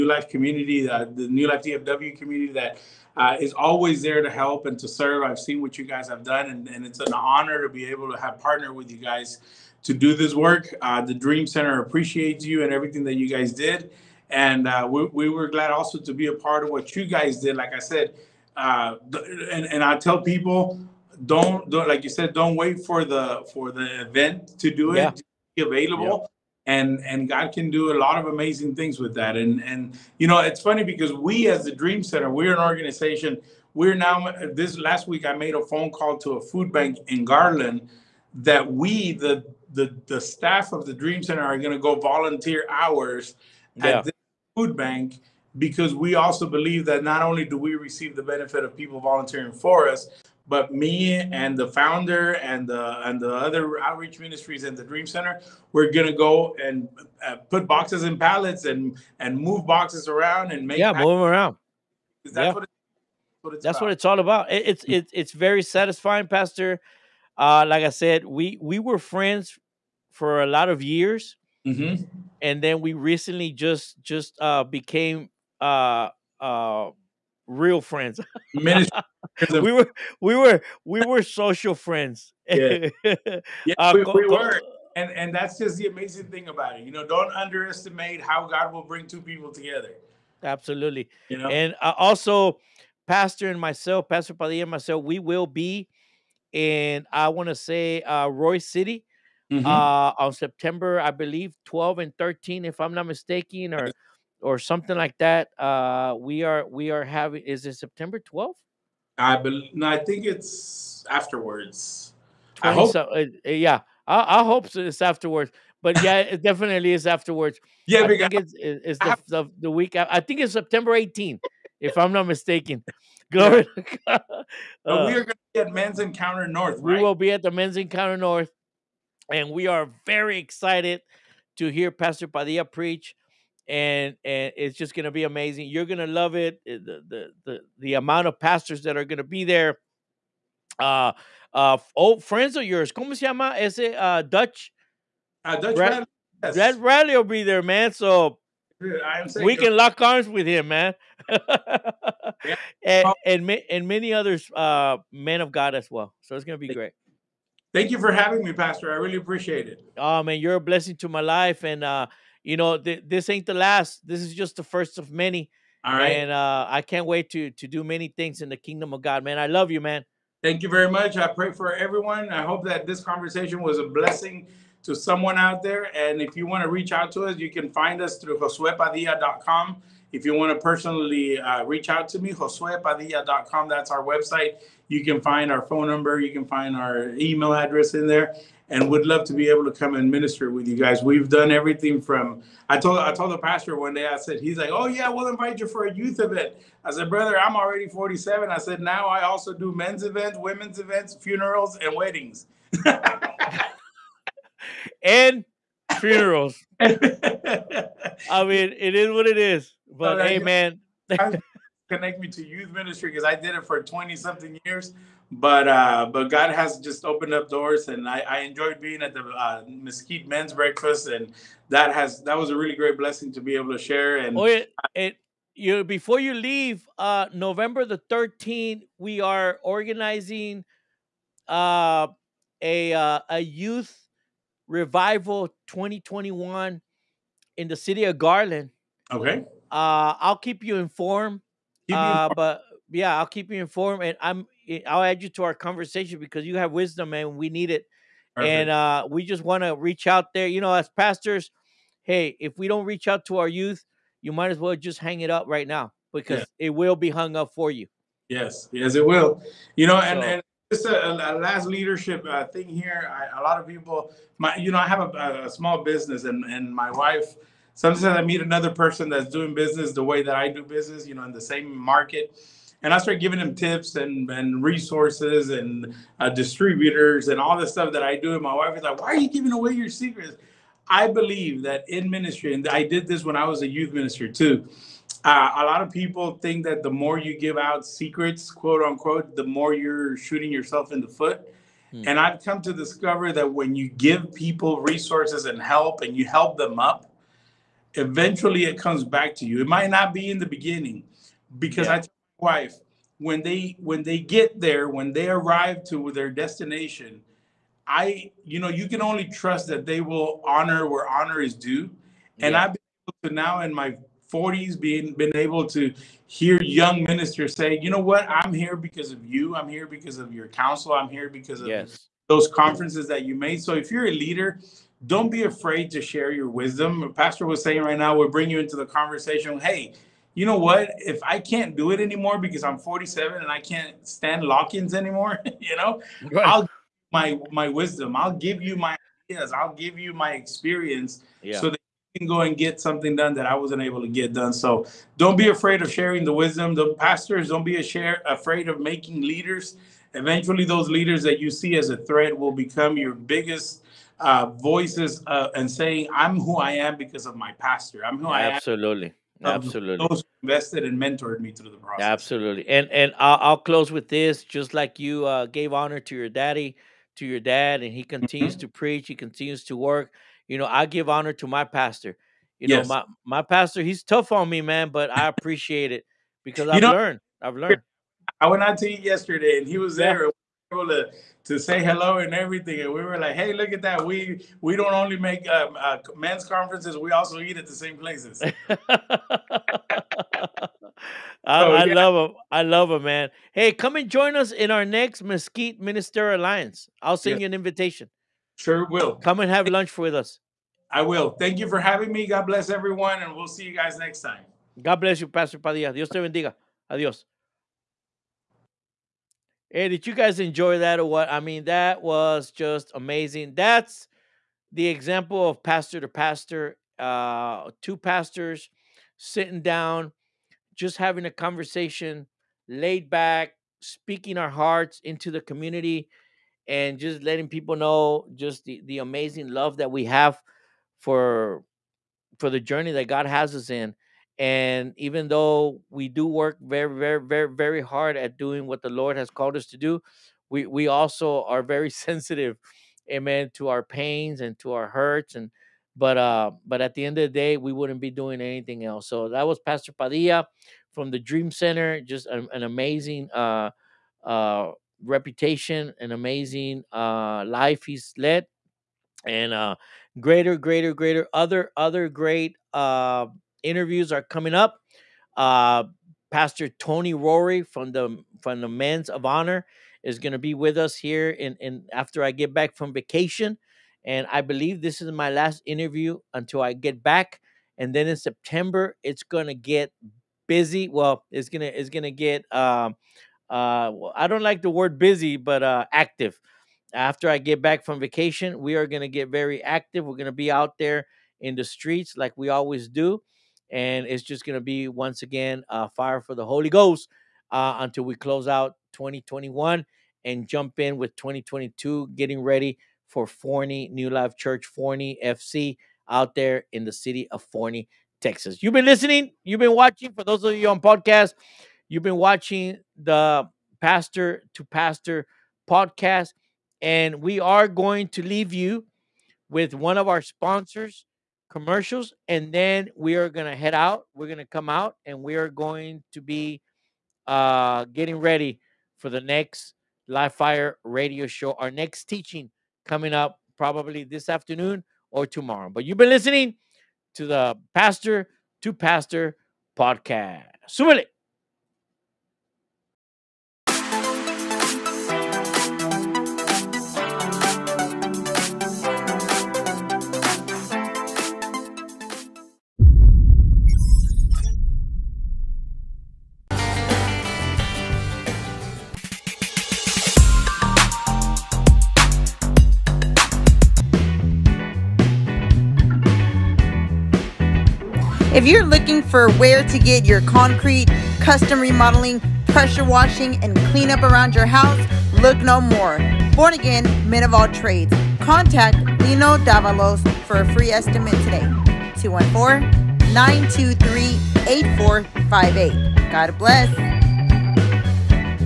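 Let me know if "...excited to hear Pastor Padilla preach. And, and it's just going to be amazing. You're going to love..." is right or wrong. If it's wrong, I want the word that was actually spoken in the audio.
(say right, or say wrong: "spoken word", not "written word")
right.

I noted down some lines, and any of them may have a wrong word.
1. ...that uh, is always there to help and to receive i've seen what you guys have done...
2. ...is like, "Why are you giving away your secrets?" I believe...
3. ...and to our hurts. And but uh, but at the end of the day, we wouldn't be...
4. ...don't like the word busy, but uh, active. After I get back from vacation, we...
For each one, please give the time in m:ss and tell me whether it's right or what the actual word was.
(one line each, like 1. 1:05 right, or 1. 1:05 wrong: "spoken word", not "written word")
1. 0:02 wrong: "serve", not "receive"
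2. 4:38 right
3. 7:24 right
4. 8:04 right.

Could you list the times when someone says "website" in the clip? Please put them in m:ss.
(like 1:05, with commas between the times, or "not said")
3:04.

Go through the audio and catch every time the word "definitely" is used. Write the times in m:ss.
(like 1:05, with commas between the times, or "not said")
1:56.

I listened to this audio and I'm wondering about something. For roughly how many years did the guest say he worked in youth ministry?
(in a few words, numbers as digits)
twenty something years.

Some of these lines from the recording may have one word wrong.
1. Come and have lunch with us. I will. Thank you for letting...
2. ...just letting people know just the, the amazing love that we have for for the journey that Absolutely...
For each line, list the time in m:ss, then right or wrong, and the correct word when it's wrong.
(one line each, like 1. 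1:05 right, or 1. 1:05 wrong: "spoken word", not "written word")
1. 6:39 wrong: "having", not "letting"
2. 7:06 wrong: "God", not "Absolutely".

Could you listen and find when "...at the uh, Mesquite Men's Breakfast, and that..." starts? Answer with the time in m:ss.
3:39.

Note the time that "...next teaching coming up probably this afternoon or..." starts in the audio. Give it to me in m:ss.
8:51.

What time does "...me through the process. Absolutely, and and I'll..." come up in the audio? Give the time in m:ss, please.
6:01.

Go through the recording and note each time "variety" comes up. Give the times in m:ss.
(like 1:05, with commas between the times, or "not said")
not said.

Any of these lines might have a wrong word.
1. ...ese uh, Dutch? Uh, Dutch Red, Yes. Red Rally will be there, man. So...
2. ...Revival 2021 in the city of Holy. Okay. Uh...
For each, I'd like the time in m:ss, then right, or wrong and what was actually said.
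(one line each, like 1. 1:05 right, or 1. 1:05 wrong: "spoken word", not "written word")
1. 2:23 right
2. 3:54 wrong: "Garland", not "Holy".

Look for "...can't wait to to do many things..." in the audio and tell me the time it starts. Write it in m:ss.
2:46.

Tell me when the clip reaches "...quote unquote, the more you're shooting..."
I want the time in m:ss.
4:48.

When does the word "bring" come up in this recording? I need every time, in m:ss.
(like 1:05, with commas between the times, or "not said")
1:28, 5:28.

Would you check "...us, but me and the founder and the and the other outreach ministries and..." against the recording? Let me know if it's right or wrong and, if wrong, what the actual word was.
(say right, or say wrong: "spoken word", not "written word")
right.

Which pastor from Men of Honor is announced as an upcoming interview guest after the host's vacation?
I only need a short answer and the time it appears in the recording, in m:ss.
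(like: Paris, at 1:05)
Tony Rory, at 7:46.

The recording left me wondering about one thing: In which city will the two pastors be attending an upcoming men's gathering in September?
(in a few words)
Royse City.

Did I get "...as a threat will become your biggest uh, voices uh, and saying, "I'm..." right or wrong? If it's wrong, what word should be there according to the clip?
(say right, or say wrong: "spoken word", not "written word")
right.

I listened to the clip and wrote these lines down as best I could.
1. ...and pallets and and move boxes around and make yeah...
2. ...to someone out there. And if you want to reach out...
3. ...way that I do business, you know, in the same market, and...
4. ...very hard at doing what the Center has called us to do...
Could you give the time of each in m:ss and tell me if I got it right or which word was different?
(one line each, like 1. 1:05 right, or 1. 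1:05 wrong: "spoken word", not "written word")
1. 0:58 right
2. 2:54 right
3. 4:30 right
4. 7:17 wrong: "Lord", not "Center".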